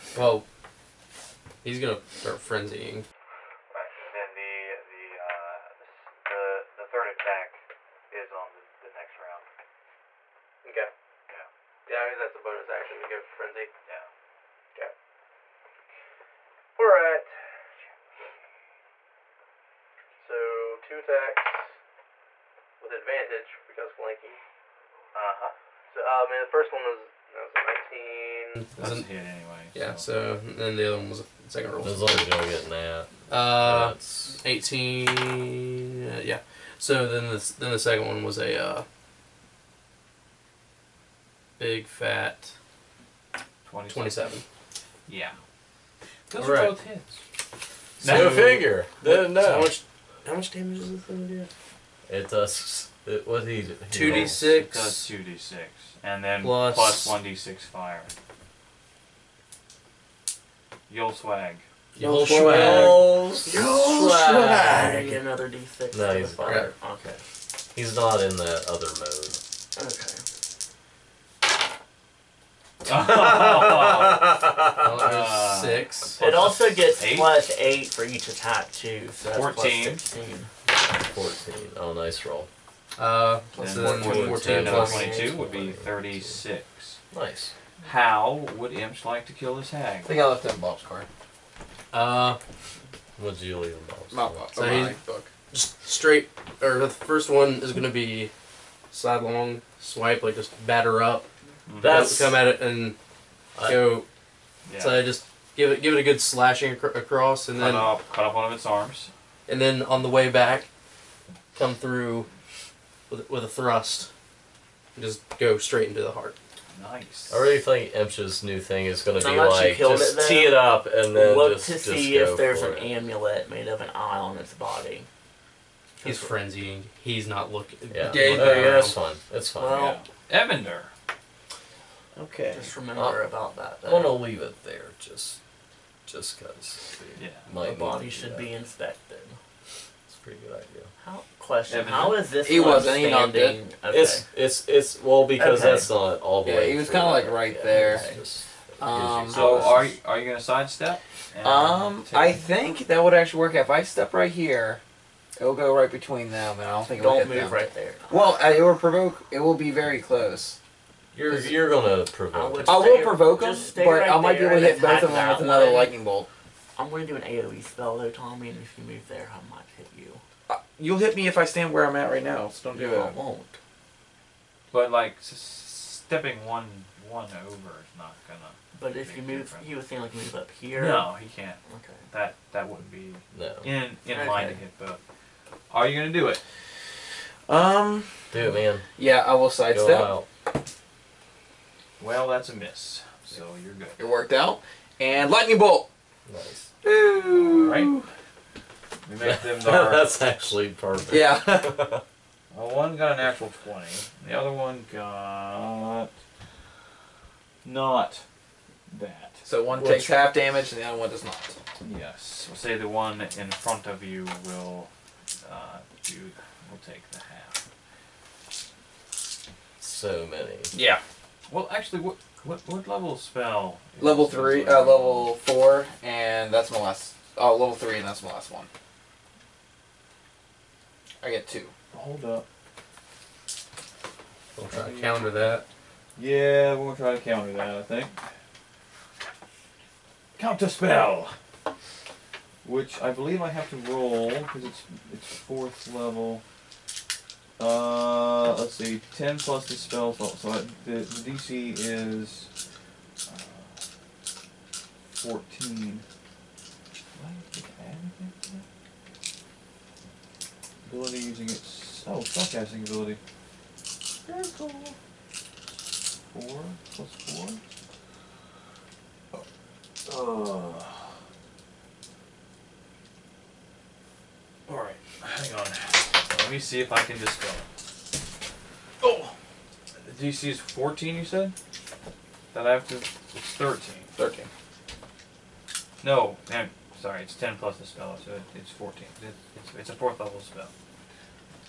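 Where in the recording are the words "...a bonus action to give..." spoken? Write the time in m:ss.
0:12.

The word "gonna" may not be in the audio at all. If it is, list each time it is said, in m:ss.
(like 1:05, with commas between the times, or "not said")
0:01, 2:13, 2:30, 2:41, 2:58, 3:05.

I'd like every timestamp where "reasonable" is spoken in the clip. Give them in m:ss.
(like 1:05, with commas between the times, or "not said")
not said.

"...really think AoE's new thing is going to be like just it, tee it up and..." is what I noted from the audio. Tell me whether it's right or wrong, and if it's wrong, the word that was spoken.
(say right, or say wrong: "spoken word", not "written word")
wrong: "Emsh", not "AoE".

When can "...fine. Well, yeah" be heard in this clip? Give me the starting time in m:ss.
2:09.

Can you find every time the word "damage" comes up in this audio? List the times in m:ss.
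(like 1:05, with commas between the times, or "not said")
0:50, 3:30.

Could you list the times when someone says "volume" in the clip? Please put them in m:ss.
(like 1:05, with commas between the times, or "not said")
not said.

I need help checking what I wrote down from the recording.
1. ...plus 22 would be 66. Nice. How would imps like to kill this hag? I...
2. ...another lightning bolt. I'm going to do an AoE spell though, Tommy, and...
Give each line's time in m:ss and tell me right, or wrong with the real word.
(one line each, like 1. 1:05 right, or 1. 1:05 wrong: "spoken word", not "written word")
1. 1:24 wrong: "36", not "66"
2. 2:45 right.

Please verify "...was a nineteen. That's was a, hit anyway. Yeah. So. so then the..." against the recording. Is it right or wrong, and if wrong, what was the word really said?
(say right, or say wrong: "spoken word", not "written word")
right.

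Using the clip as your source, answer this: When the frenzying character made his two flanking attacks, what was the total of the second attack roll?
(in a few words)
27.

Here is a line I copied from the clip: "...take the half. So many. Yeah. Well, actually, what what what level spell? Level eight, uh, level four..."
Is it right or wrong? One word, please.
wrong.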